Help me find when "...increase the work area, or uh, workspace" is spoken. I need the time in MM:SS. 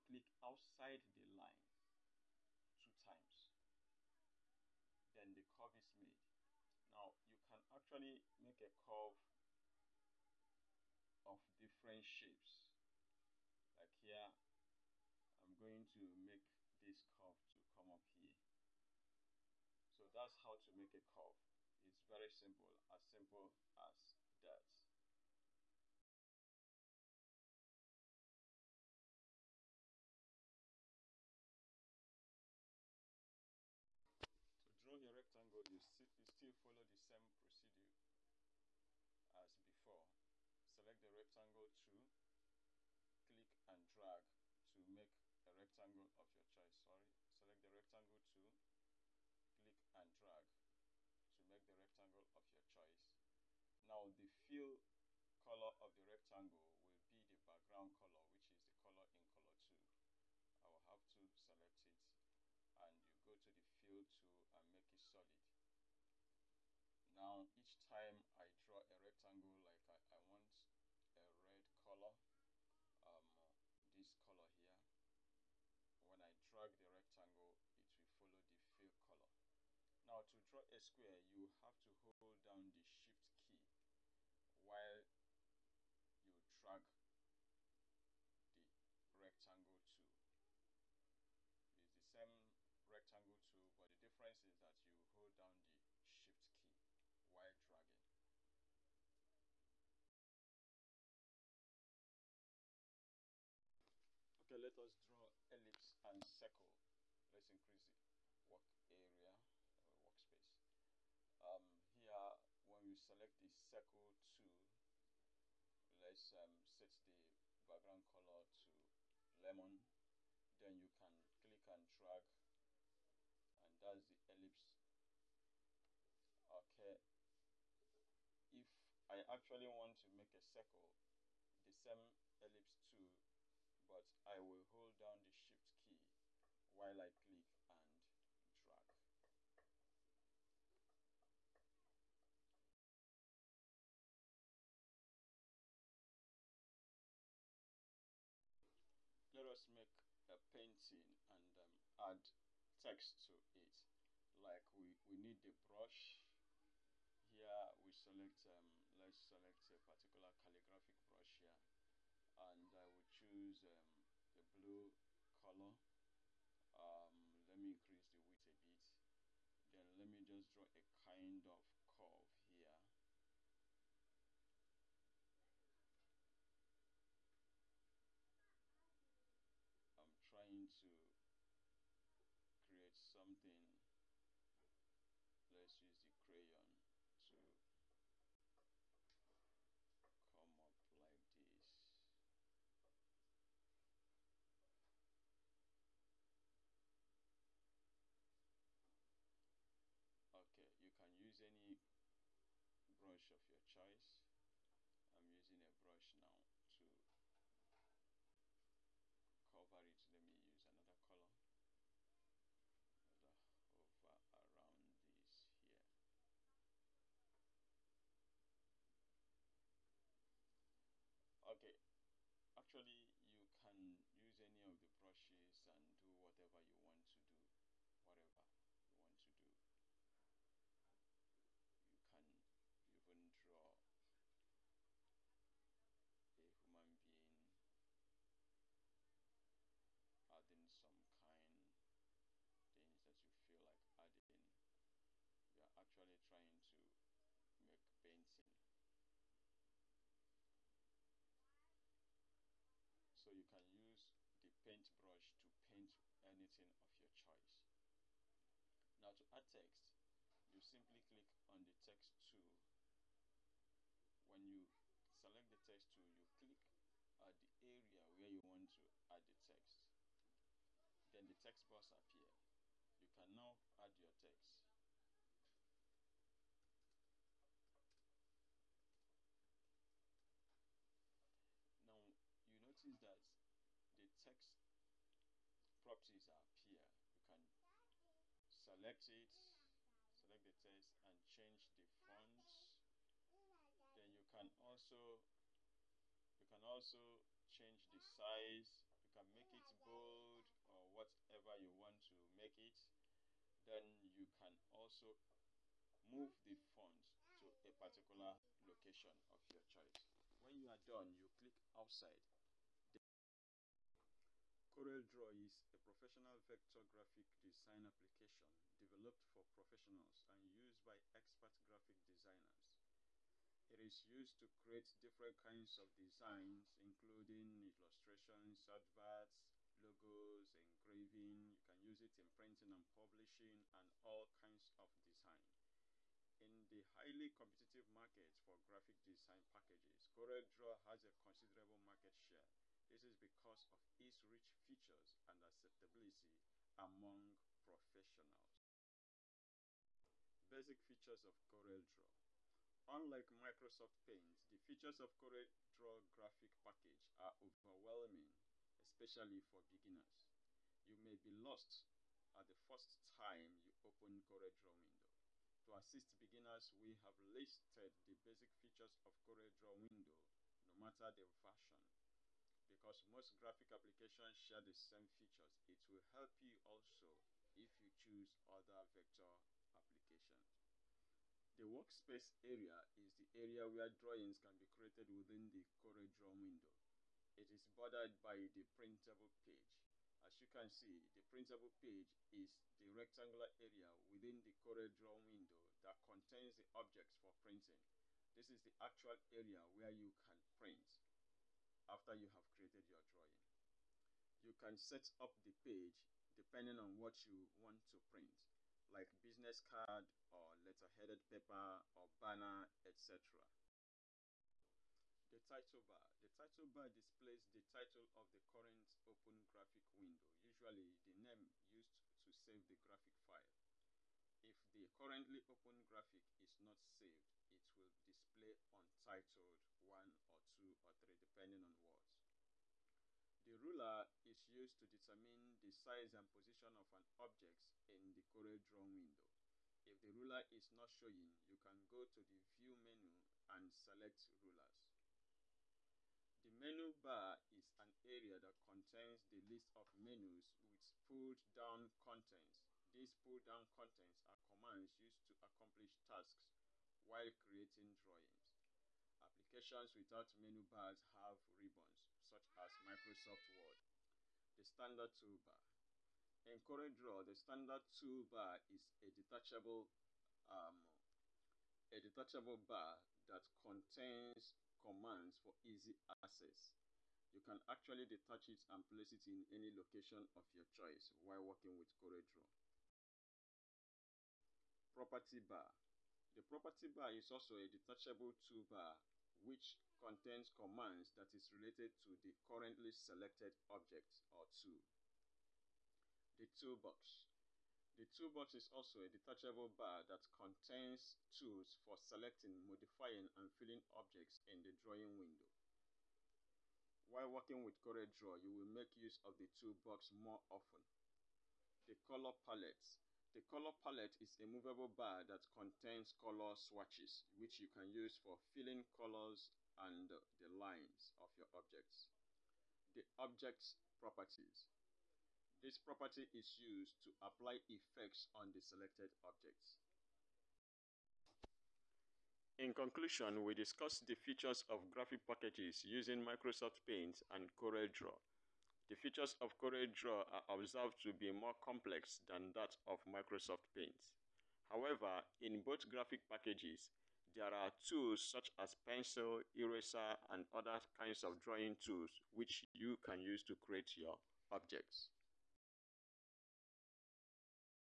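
01:47.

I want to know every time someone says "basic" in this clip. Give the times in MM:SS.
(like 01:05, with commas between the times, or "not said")
05:50, 06:08.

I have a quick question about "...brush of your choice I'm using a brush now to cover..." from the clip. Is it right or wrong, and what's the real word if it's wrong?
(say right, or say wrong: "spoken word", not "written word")
right.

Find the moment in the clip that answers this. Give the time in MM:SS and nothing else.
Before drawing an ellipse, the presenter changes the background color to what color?
01:59.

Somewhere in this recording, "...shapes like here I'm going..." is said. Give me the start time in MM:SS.
00:12.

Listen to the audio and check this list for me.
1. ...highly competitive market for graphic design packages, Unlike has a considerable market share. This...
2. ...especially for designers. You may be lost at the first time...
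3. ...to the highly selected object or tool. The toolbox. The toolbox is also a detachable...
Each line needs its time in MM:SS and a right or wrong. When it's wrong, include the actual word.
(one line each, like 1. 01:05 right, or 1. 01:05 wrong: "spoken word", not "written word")
1. 05:36 wrong: "CorelDRAW", not "Unlike"
2. 05:58 wrong: "beginners", not "designers"
3. 08:11 wrong: "currently", not "highly".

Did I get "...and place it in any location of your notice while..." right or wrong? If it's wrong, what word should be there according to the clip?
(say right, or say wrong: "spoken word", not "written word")
wrong: "choice", not "notice".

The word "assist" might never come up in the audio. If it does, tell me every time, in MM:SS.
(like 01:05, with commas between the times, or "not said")
06:05.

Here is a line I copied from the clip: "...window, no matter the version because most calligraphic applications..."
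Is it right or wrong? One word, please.
wrong.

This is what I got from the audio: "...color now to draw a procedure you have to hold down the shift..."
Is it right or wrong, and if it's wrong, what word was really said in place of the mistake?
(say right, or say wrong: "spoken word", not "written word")
wrong: "square", not "procedure".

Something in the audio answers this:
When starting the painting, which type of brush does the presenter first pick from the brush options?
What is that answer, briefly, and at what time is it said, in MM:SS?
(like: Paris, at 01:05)
Calligraphic brush, at 02:40.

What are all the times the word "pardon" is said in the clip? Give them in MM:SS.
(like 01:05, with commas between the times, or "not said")
not said.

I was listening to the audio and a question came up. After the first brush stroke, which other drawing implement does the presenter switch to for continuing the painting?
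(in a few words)
Crayon.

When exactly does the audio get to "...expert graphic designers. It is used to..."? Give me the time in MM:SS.
05:21.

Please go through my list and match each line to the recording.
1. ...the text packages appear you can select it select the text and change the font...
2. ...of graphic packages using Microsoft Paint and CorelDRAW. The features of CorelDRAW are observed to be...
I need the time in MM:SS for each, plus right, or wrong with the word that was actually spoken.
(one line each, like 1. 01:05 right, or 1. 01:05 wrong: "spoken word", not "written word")
1. 04:43 wrong: "properties", not "packages"
2. 08:54 right.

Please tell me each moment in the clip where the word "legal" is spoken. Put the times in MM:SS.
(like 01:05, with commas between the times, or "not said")
not said.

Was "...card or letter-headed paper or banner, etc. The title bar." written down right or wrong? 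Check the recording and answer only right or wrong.
right.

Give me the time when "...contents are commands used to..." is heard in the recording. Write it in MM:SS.
07:33.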